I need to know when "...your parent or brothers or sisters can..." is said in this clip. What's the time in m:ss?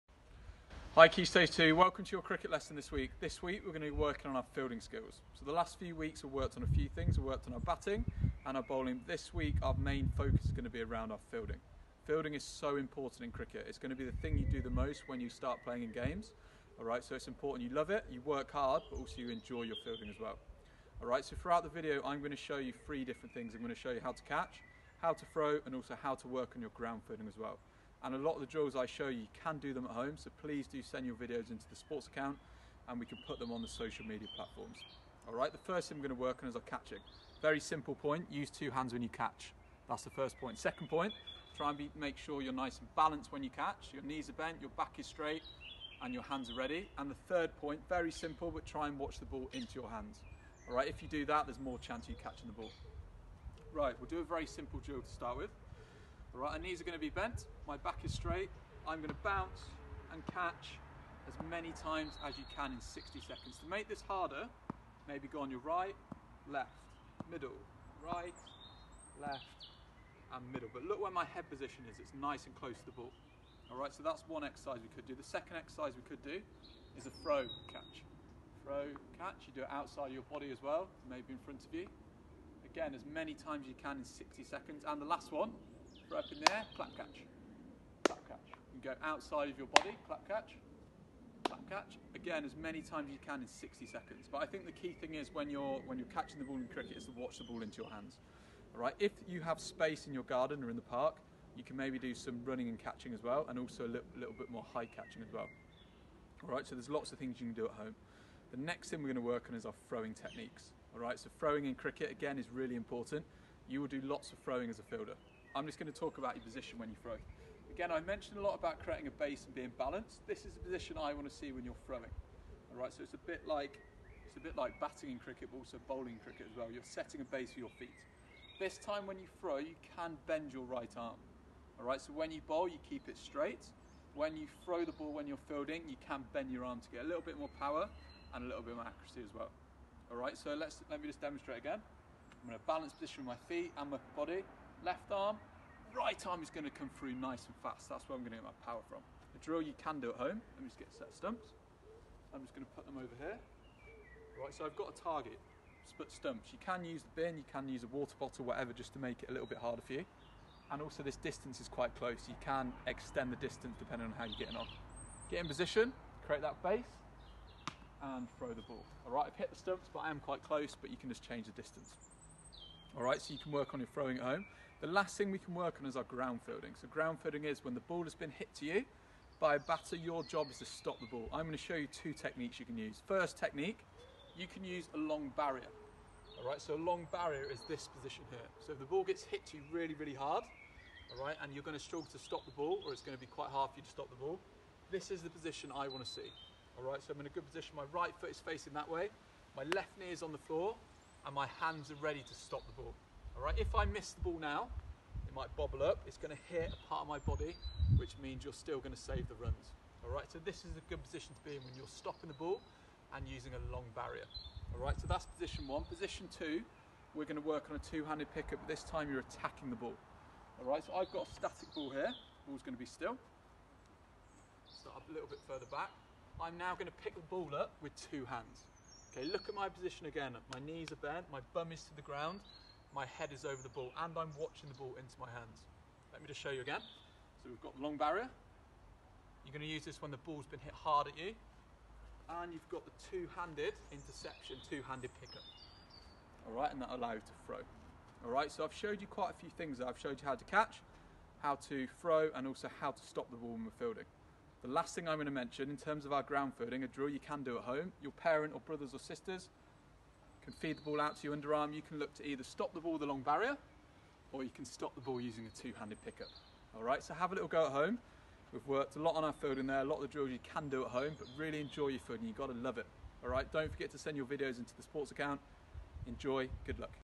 4:18.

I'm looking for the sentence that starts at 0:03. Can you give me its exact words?
This week we're going to be working on our fielding skills.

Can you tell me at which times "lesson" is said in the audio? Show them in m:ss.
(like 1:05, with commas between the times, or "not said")
0:02.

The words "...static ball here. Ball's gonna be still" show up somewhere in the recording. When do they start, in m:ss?
3:41.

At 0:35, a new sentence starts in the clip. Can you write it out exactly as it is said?
All right, the first thing we're going to work on is our catching.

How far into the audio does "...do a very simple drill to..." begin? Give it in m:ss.
0:54.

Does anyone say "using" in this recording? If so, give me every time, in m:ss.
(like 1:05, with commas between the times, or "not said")
3:33, 4:25.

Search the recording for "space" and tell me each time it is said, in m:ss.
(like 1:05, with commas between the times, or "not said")
1:39.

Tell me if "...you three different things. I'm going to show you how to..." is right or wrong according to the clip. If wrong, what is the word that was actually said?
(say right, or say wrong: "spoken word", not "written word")
right.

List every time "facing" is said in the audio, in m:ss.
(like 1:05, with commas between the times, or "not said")
3:18.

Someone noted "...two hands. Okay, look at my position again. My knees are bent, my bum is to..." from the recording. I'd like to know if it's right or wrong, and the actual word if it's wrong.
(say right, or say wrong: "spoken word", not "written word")
right.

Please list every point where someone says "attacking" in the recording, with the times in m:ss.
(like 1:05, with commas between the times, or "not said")
3:39.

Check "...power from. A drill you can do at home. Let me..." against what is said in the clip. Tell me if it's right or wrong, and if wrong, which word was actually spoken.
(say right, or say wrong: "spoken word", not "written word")
right.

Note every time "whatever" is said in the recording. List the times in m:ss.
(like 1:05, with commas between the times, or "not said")
2:38.